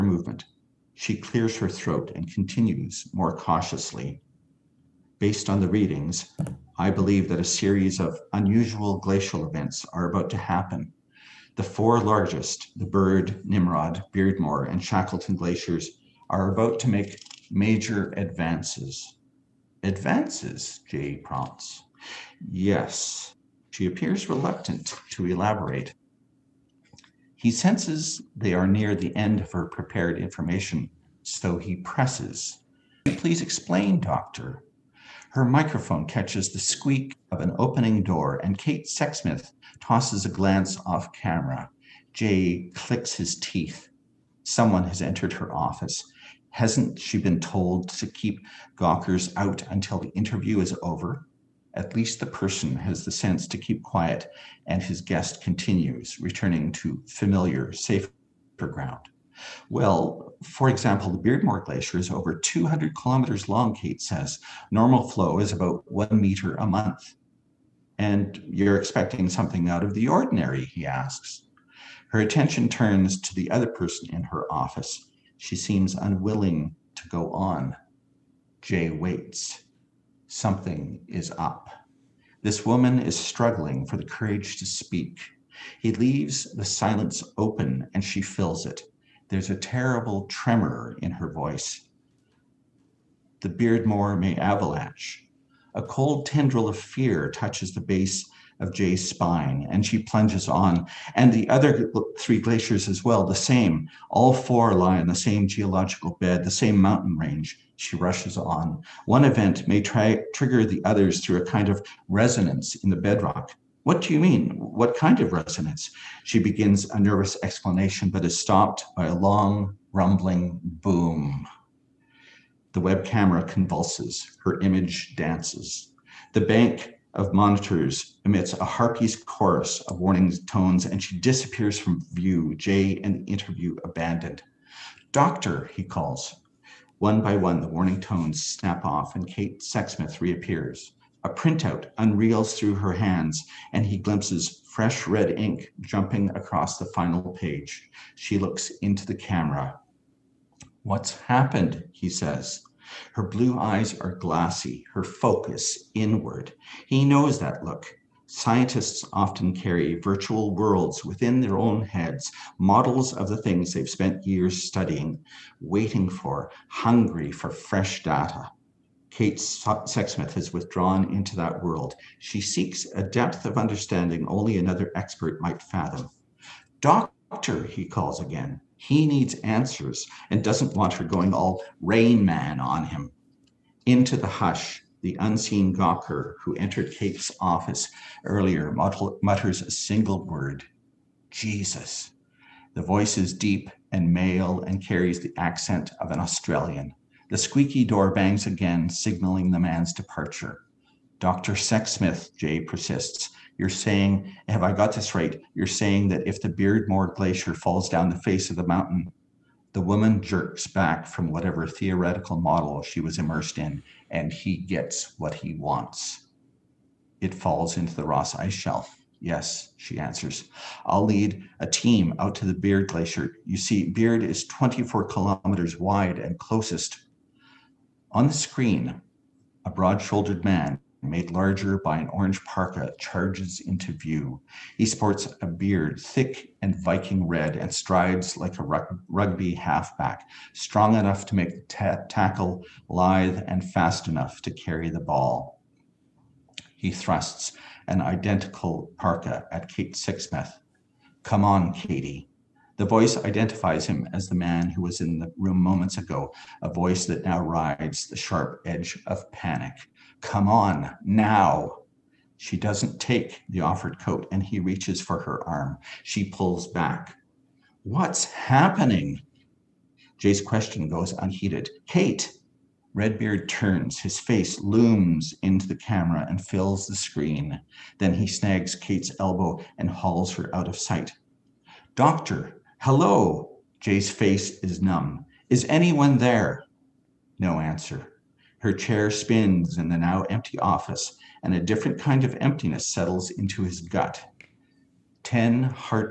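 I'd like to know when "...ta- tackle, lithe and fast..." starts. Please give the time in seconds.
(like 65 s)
241 s.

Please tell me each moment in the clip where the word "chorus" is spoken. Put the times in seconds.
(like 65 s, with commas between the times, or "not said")
129 s.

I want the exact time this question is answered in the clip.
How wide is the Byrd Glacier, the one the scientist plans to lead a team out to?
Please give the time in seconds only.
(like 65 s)
224 s.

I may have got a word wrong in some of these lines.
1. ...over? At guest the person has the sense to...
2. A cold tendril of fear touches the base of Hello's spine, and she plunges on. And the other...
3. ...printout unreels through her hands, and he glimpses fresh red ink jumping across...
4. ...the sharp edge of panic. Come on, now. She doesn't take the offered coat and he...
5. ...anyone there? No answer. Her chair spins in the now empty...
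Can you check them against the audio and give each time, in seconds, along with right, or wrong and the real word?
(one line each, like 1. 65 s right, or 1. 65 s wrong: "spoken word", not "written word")
1. 50 s wrong: "least", not "guest"
2. 95 s wrong: "Jay", not "Hello"
3. 141 s right
4. 258 s right
5. 285 s right.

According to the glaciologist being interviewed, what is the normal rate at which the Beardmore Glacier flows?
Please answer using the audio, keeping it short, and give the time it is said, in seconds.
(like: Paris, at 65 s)
1 meter a month, at 65 s.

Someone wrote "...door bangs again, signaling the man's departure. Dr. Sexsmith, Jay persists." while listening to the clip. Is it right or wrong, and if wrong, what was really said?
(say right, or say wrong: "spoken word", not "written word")
right.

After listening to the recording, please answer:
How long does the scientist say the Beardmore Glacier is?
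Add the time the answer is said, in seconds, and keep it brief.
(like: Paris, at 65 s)
over 200 kilometers, at 62 s.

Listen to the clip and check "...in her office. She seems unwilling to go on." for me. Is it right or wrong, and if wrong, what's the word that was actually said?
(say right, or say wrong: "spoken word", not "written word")
right.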